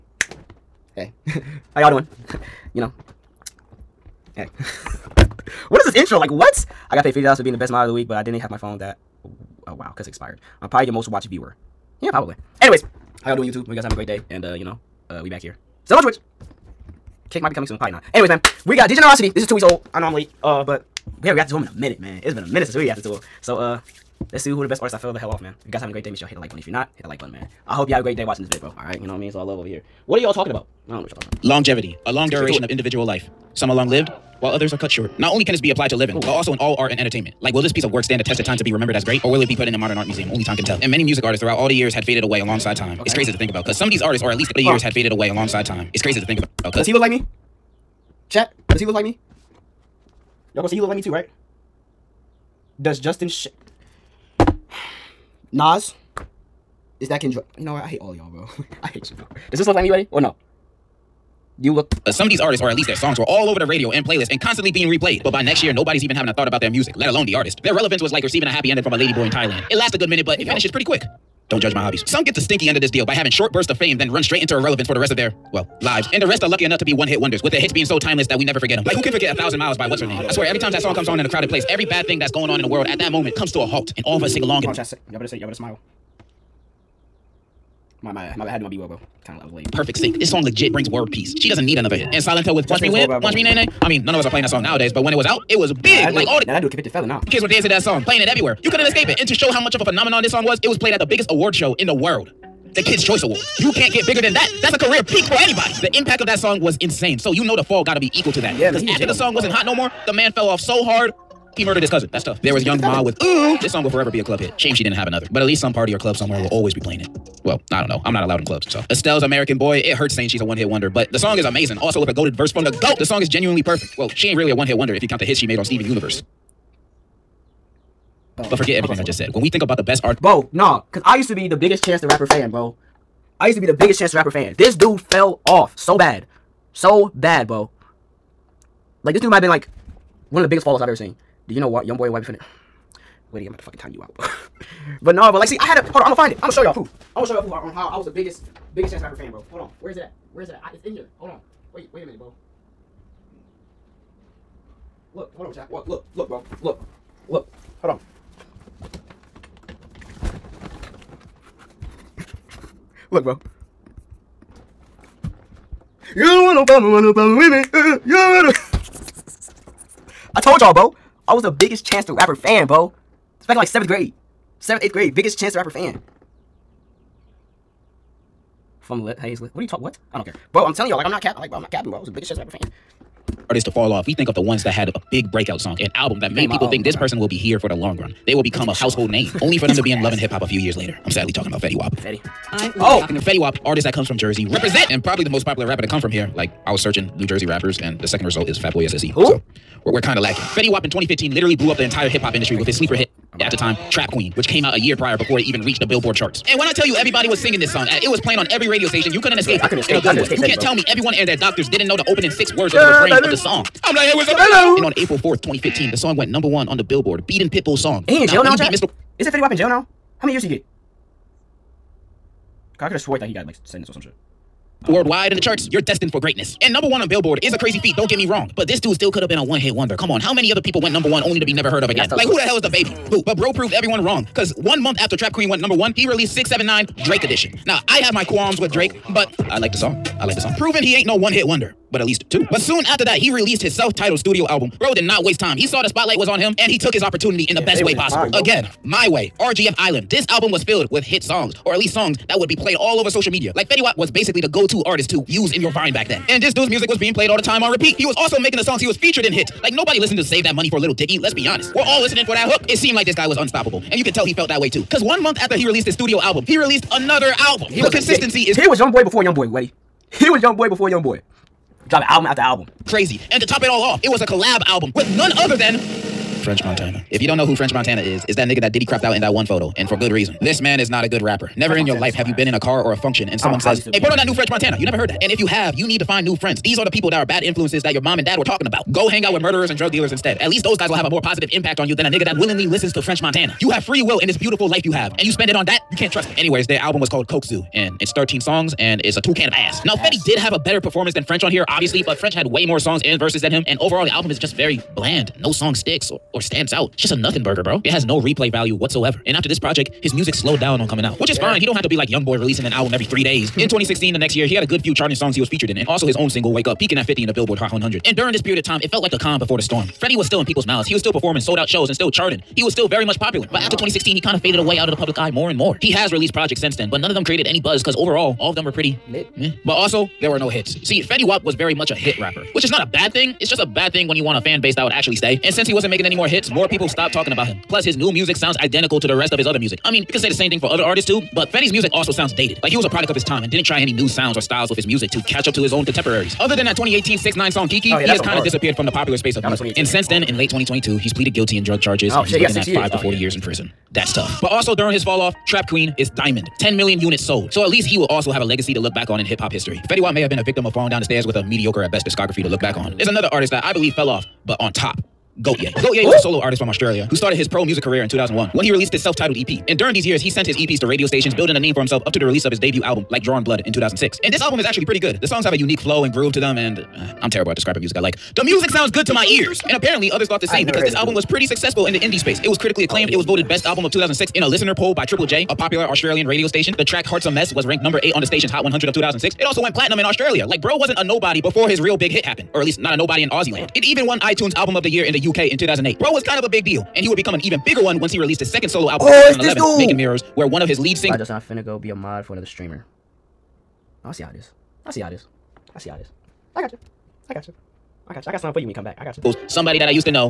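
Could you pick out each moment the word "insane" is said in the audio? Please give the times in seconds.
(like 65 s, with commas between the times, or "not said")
106 s.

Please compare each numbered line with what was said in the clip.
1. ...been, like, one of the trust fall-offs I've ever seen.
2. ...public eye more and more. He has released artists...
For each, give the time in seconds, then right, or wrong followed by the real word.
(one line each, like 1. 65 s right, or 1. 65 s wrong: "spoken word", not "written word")
1. 139 s wrong: "biggest", not "trust"
2. 324 s wrong: "projects", not "artists".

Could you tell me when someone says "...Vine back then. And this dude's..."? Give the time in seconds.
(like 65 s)
255 s.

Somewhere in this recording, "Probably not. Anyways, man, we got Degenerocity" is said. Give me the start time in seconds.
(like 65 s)
17 s.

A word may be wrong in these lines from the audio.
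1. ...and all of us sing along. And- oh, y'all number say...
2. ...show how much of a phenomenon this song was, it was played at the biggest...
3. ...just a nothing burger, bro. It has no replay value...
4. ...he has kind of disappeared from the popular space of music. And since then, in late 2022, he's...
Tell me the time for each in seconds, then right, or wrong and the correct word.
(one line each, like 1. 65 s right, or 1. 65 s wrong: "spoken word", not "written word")
1. 83 s wrong: "better", not "number"
2. 99 s right
3. 307 s right
4. 348 s right.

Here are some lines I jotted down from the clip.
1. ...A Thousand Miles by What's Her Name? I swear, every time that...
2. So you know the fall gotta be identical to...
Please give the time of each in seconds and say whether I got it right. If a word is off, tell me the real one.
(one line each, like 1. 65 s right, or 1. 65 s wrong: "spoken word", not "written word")
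1. 79 s right
2. 107 s wrong: "equal", not "identical".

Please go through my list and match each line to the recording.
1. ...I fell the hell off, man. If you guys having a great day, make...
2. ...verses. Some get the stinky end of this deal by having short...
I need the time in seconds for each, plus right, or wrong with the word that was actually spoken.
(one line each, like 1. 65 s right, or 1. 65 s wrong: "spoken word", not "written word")
1. 24 s right
2. 71 s wrong: "hobbies", not "verses".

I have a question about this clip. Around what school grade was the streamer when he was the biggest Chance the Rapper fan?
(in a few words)
seventh grade.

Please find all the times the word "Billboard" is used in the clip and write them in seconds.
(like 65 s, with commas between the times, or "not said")
205 s, 216 s, 227 s, 317 s.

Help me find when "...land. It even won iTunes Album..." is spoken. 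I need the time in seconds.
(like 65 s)
393 s.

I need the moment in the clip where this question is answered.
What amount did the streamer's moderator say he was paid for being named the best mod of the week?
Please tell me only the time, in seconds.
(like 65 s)
7 s.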